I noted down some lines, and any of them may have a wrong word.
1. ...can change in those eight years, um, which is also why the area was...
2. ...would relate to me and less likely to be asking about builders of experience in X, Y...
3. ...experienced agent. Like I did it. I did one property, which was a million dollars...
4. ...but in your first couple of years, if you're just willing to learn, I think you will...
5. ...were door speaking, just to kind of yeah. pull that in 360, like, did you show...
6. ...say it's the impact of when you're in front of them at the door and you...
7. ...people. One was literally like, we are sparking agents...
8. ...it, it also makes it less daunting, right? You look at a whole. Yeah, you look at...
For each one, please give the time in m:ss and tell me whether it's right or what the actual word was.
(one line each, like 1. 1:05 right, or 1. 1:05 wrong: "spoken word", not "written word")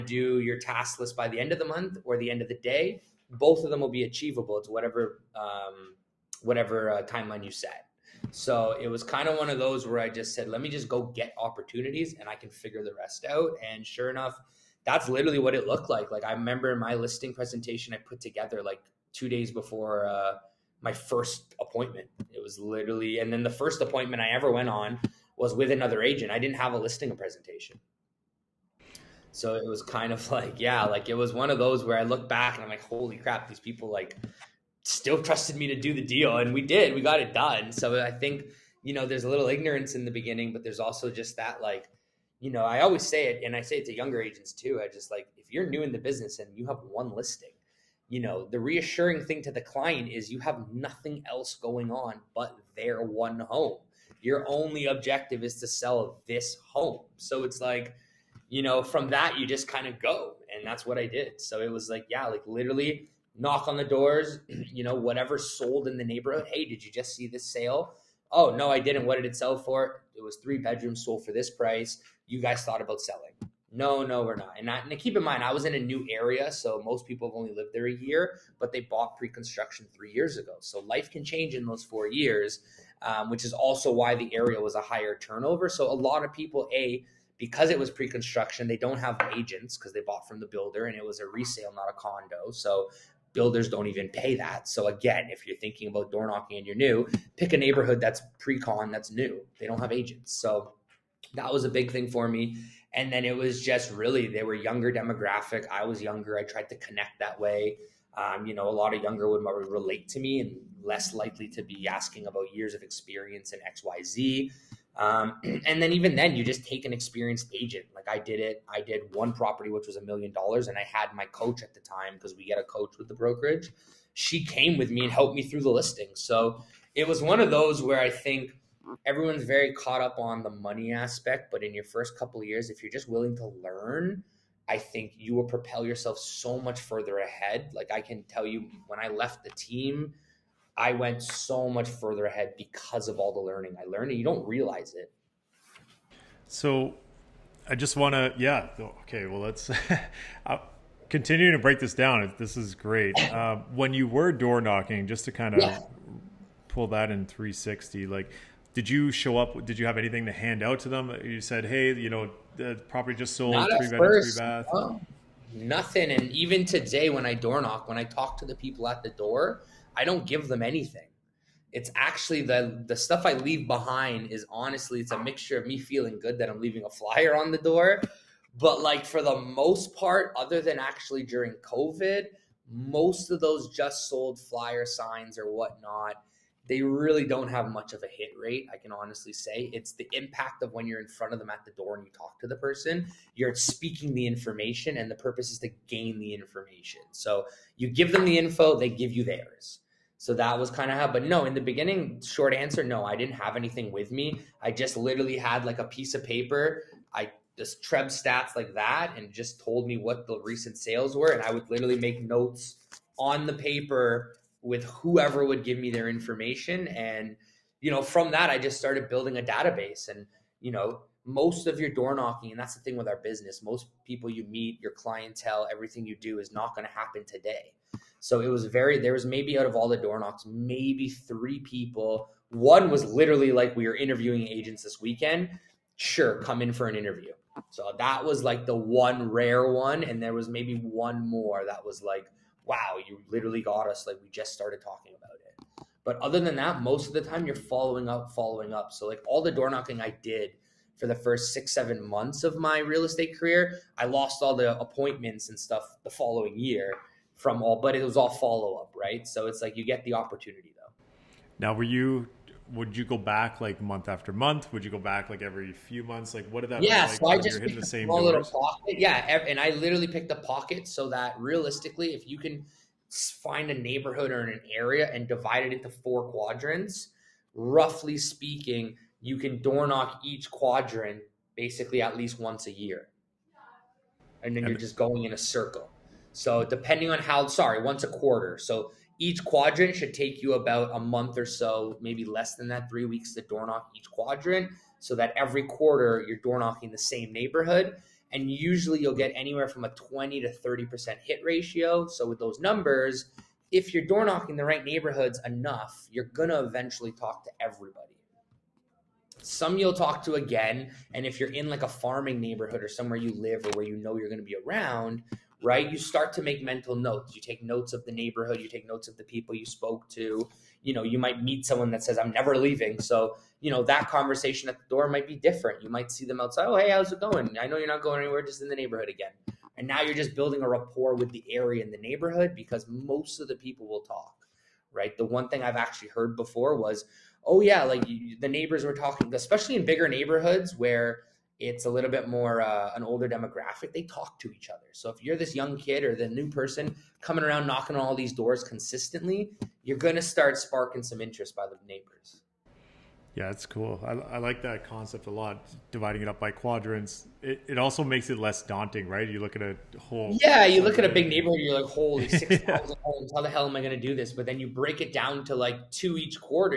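1. 1:21 wrong: "four", not "eight"
2. 1:49 wrong: "years", not "builders"
3. 1:56 right
4. 2:11 right
5. 2:34 wrong: "knocking", not "speaking"
6. 3:09 right
7. 3:51 wrong: "interviewing", not "sparking"
8. 5:57 right.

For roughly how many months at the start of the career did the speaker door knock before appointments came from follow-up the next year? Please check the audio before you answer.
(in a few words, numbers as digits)
6 or 7 months.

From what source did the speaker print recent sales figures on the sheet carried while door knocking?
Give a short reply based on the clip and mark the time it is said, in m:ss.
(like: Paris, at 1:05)
TREB, at 3:27.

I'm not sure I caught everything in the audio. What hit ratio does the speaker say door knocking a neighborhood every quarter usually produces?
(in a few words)
20 to 30%.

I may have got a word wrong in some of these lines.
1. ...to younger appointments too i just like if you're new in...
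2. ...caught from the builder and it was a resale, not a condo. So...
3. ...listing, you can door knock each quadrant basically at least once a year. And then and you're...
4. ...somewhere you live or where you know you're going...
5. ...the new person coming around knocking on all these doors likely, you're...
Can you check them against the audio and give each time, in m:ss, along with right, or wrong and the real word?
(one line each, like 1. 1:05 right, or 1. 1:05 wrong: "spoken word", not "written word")
1. 0:43 wrong: "agents", not "appointments"
2. 1:30 wrong: "bought", not "caught"
3. 4:38 wrong: "speaking", not "listing"
4. 5:12 right
5. 5:46 wrong: "consistently", not "likely".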